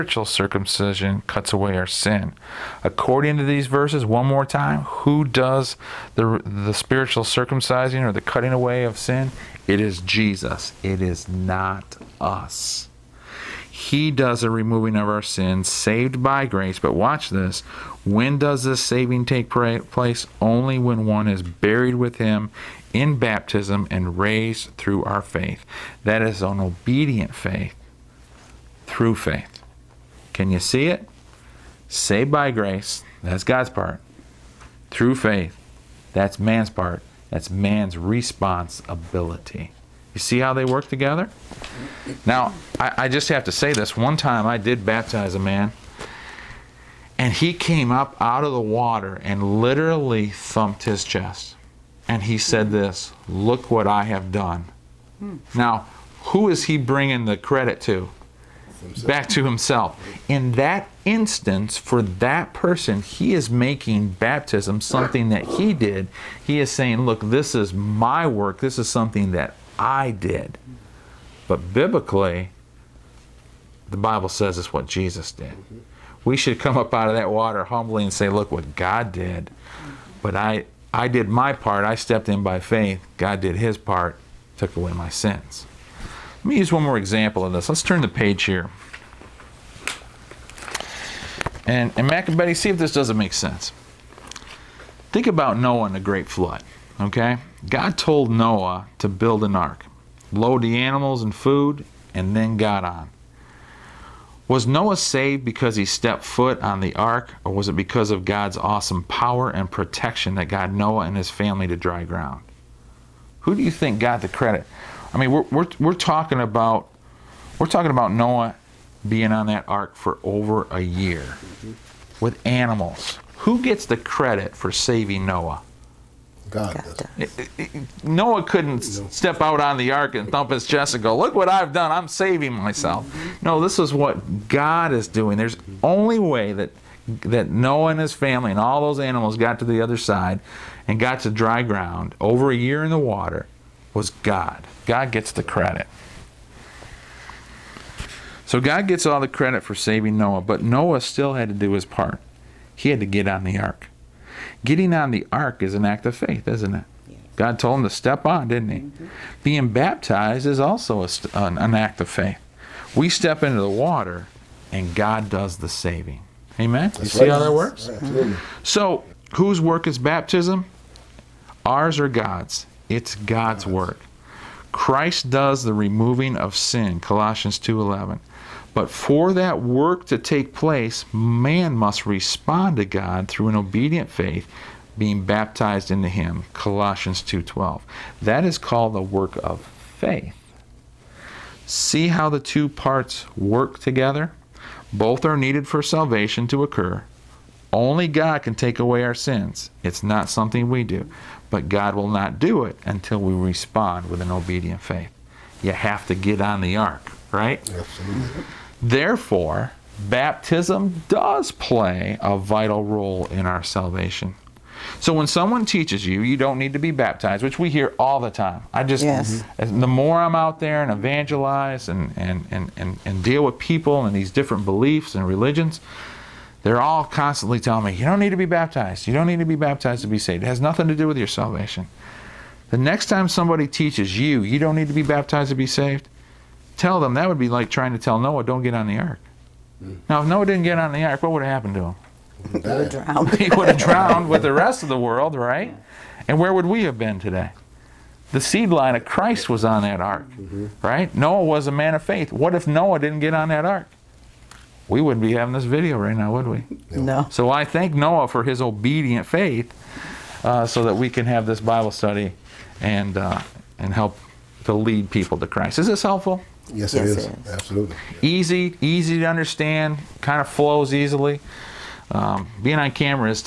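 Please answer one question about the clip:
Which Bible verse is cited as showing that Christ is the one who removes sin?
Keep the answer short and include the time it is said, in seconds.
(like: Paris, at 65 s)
Colossians 2:11, at 176 s.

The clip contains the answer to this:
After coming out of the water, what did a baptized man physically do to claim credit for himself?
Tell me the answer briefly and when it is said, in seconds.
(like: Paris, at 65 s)
thumped his chest, at 50 s.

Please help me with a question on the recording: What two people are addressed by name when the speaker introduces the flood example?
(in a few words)
Mac and Betty.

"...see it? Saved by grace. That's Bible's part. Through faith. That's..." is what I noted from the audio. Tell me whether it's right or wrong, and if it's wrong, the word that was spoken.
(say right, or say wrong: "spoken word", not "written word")
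wrong: "God", not "Bible".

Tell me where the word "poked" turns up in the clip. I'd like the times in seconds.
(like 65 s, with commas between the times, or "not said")
not said.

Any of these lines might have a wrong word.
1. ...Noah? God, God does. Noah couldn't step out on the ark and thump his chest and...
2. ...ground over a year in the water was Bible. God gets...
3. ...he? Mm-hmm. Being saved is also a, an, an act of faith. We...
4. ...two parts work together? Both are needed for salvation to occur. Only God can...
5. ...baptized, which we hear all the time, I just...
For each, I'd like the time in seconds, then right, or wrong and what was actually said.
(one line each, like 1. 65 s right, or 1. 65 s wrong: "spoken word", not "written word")
1. 125 s right
2. 141 s wrong: "God", not "Bible"
3. 158 s wrong: "baptized", not "saved"
4. 192 s right
5. 216 s right.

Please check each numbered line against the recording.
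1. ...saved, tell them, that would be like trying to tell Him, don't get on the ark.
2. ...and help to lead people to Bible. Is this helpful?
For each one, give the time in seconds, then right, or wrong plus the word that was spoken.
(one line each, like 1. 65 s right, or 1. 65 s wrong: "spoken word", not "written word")
1. 235 s wrong: "Noah", not "Him"
2. 263 s wrong: "Christ", not "Bible".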